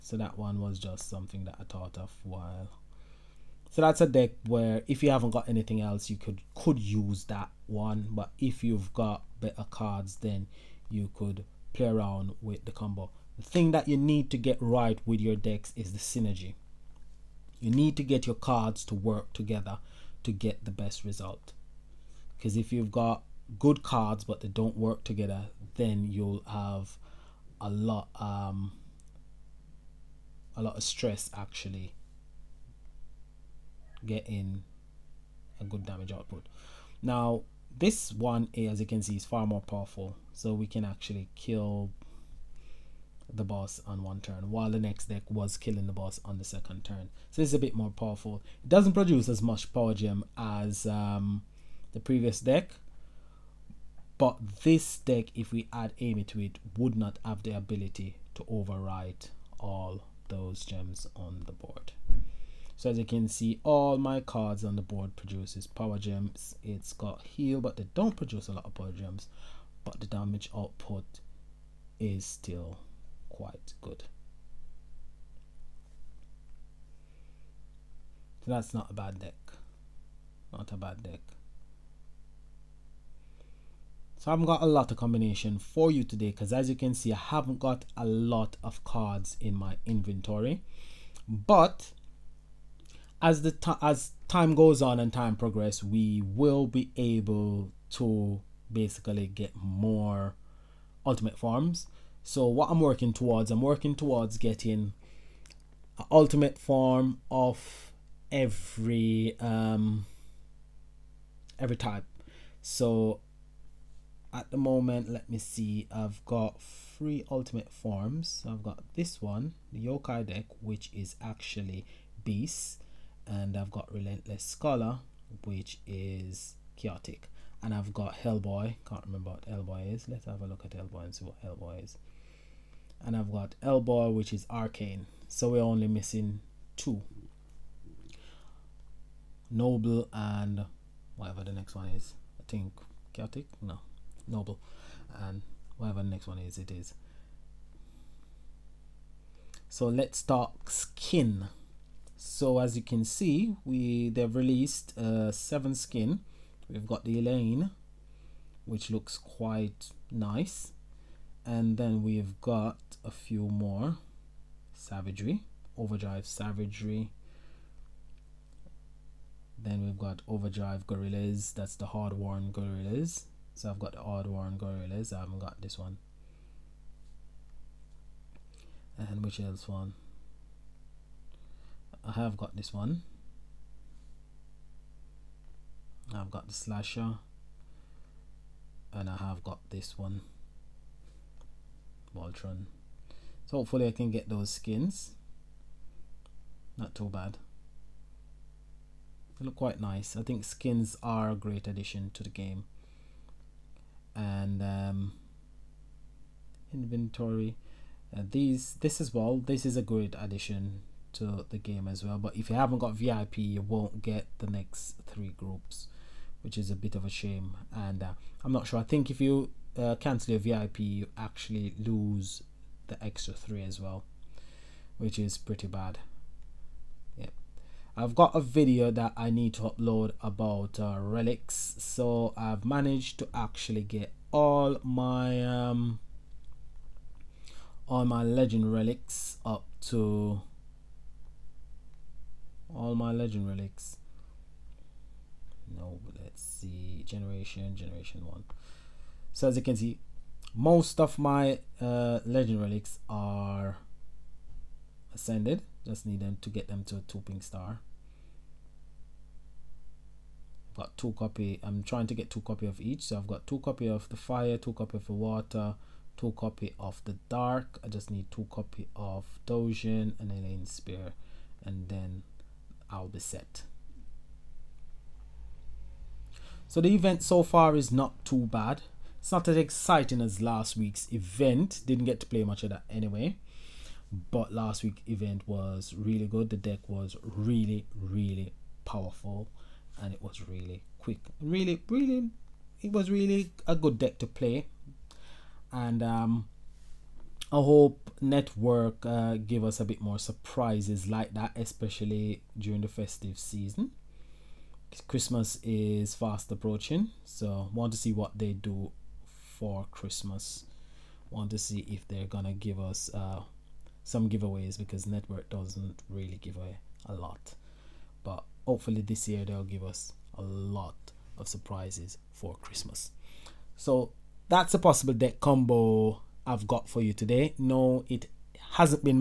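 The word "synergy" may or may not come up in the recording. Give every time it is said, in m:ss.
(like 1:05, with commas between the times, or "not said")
0:15.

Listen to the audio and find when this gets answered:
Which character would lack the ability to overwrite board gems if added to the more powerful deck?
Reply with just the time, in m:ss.
0:55.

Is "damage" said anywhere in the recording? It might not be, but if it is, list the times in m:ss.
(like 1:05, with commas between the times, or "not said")
0:35, 1:10.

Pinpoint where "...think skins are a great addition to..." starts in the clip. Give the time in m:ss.
3:20.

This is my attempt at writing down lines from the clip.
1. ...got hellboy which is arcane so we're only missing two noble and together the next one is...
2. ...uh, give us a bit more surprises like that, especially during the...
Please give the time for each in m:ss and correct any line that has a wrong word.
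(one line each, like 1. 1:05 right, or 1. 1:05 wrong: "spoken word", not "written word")
1. 2:13 wrong: "whatever", not "together"
2. 4:59 right.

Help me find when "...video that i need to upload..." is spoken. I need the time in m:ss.
3:48.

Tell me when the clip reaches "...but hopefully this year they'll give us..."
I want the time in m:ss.
5:18.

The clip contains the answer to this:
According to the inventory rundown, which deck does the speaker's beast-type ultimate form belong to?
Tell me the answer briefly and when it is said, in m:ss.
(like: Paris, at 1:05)
yokai deck, at 1:59.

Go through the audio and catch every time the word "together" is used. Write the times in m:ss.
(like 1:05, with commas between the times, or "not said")
0:19, 0:25.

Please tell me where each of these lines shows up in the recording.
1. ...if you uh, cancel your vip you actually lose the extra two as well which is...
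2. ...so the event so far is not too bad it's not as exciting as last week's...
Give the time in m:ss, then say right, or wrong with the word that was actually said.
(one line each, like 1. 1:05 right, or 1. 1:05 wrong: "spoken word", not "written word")
1. 3:39 wrong: "three", not "two"
2. 4:36 right.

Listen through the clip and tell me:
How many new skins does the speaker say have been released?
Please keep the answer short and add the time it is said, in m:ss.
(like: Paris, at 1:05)
7, at 2:35.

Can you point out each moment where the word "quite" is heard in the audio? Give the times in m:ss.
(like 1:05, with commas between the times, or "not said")
1:13, 2:39, 3:19.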